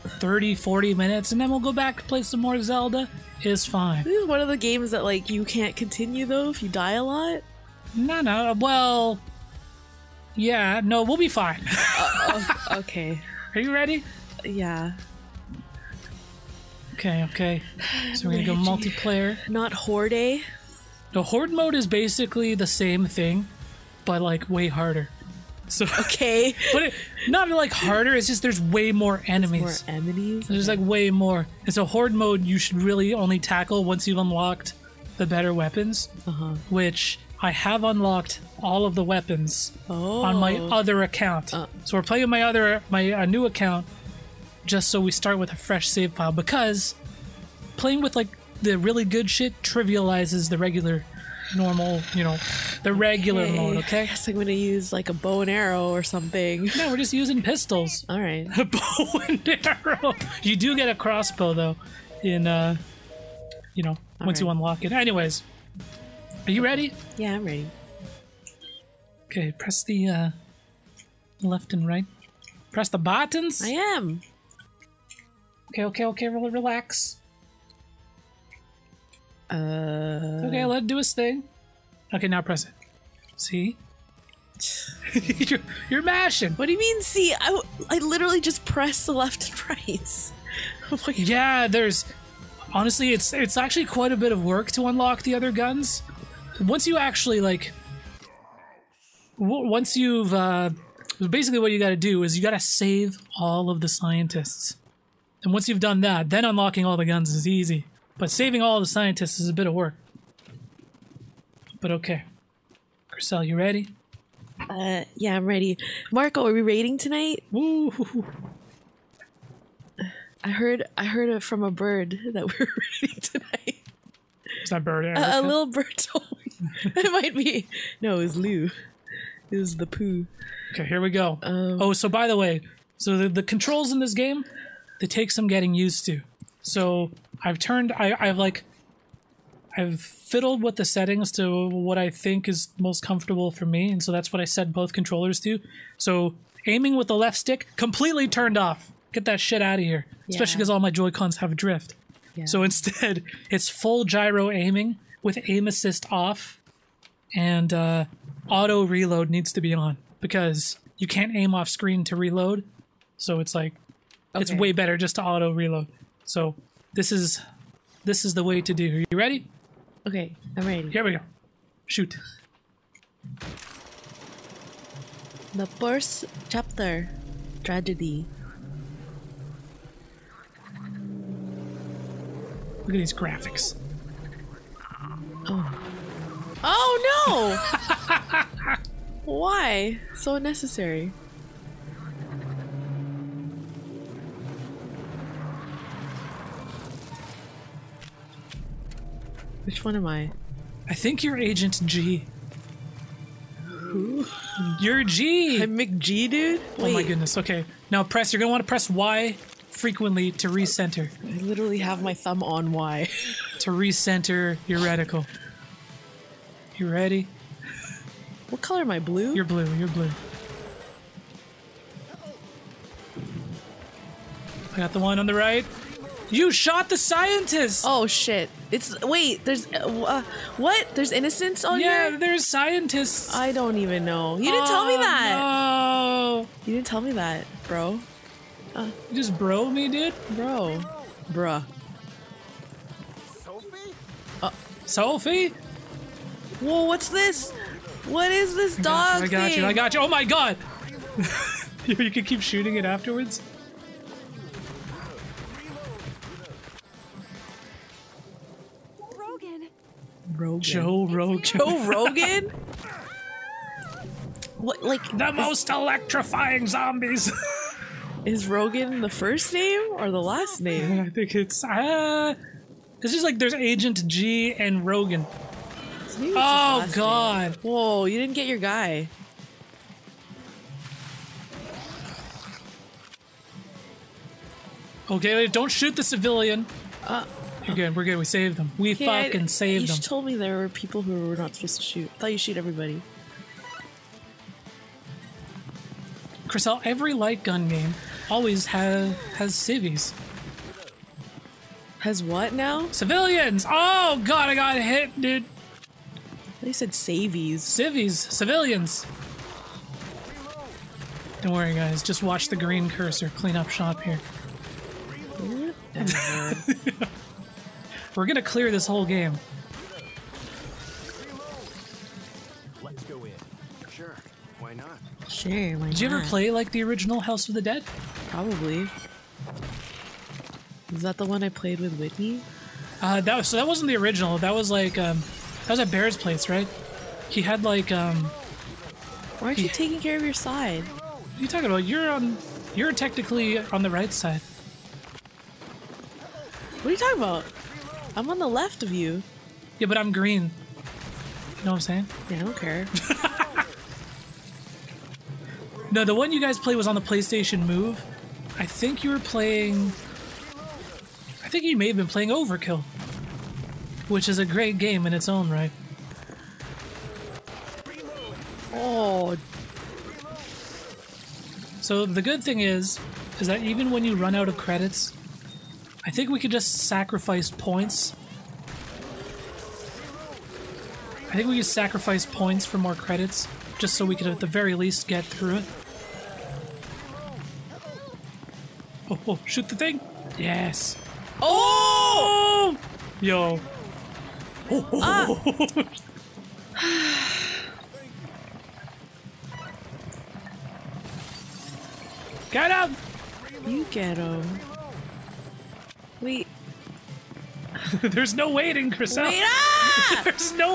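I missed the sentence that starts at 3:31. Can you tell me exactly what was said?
I literally have my thumb on Y.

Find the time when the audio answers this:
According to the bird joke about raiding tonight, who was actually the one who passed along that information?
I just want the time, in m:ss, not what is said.
2:08.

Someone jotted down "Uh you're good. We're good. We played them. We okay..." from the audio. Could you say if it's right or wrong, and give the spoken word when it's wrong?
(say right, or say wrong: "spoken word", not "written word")
wrong: "saved", not "played".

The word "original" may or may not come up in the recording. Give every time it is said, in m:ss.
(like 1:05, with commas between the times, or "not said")
5:26, 5:33.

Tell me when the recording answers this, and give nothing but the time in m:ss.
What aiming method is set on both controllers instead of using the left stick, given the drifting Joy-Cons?
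2:33.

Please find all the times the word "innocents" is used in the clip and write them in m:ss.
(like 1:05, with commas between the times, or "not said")
3:51.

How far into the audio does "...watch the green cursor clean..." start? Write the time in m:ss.
5:12.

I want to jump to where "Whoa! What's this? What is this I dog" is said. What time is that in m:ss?
4:06.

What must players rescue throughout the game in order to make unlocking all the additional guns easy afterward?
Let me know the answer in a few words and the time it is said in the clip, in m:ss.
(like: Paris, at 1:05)
All the scientists, at 1:42.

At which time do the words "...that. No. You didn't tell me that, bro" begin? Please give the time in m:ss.
3:54.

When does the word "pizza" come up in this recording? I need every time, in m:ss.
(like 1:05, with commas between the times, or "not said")
not said.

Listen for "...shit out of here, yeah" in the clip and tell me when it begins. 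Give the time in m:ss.
2:29.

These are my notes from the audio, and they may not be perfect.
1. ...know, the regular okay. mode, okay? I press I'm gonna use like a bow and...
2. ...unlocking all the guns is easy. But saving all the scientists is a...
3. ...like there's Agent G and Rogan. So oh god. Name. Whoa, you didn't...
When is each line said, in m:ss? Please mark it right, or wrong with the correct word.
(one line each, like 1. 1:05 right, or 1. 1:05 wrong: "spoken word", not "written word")
1. 0:52 wrong: "guess", not "press"
2. 1:46 right
3. 4:33 right.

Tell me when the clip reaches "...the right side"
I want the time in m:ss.
5:43.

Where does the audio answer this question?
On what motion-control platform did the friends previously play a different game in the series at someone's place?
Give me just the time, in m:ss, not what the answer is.
5:57.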